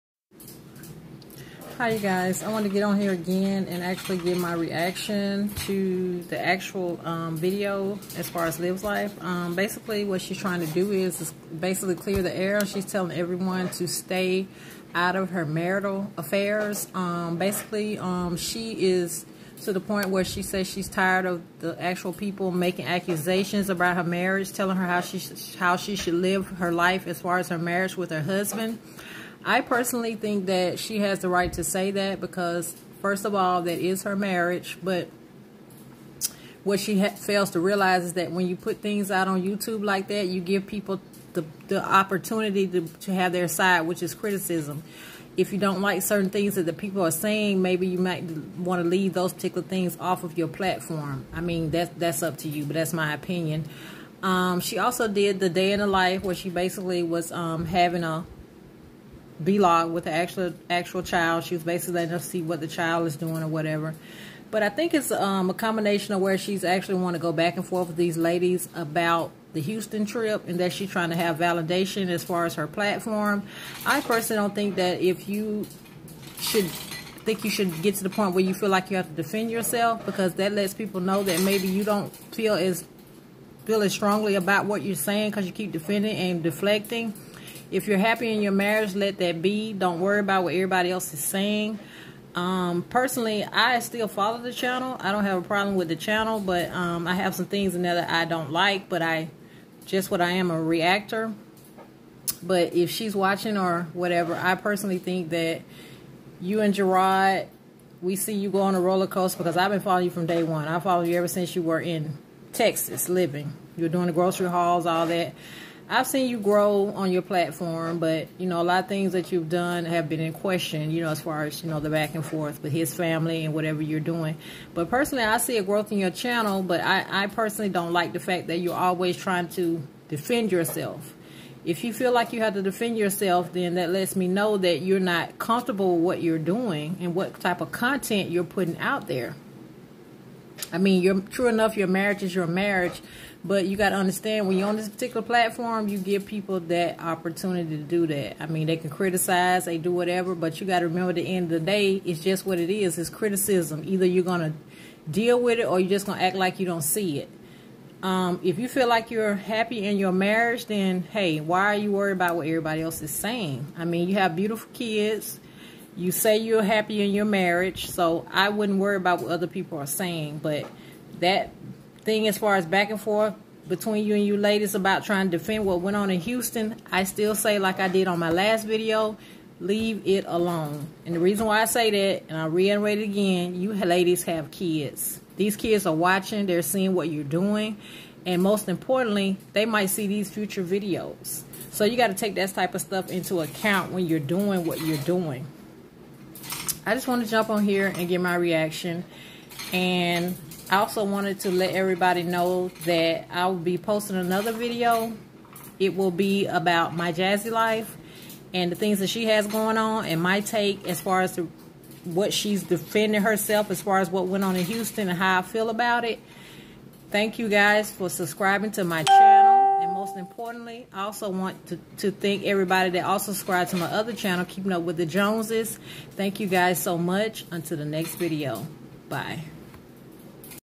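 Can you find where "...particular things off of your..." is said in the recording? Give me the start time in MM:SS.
00:49.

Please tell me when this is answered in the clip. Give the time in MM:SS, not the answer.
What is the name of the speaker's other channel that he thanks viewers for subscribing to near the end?
03:44.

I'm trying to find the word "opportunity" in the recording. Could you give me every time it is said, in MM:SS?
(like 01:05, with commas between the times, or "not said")
00:41, 02:27.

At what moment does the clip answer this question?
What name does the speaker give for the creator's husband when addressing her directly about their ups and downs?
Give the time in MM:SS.
01:46.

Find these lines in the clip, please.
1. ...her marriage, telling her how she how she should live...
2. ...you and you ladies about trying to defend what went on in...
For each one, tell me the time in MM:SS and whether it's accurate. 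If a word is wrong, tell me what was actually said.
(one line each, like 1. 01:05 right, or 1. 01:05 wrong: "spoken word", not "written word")
1. 00:23 right
2. 02:54 right.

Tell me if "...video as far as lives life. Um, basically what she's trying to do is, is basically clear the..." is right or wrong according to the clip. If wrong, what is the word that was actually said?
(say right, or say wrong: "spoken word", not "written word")
right.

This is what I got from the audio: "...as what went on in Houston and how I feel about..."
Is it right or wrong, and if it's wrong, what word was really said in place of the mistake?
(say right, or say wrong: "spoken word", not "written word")
right.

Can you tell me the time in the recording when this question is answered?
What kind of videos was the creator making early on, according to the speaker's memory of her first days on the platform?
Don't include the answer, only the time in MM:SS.
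01:54.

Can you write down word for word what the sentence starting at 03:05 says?
These kids are watching, they're seeing what you're doing, and most importantly, they might see these future videos.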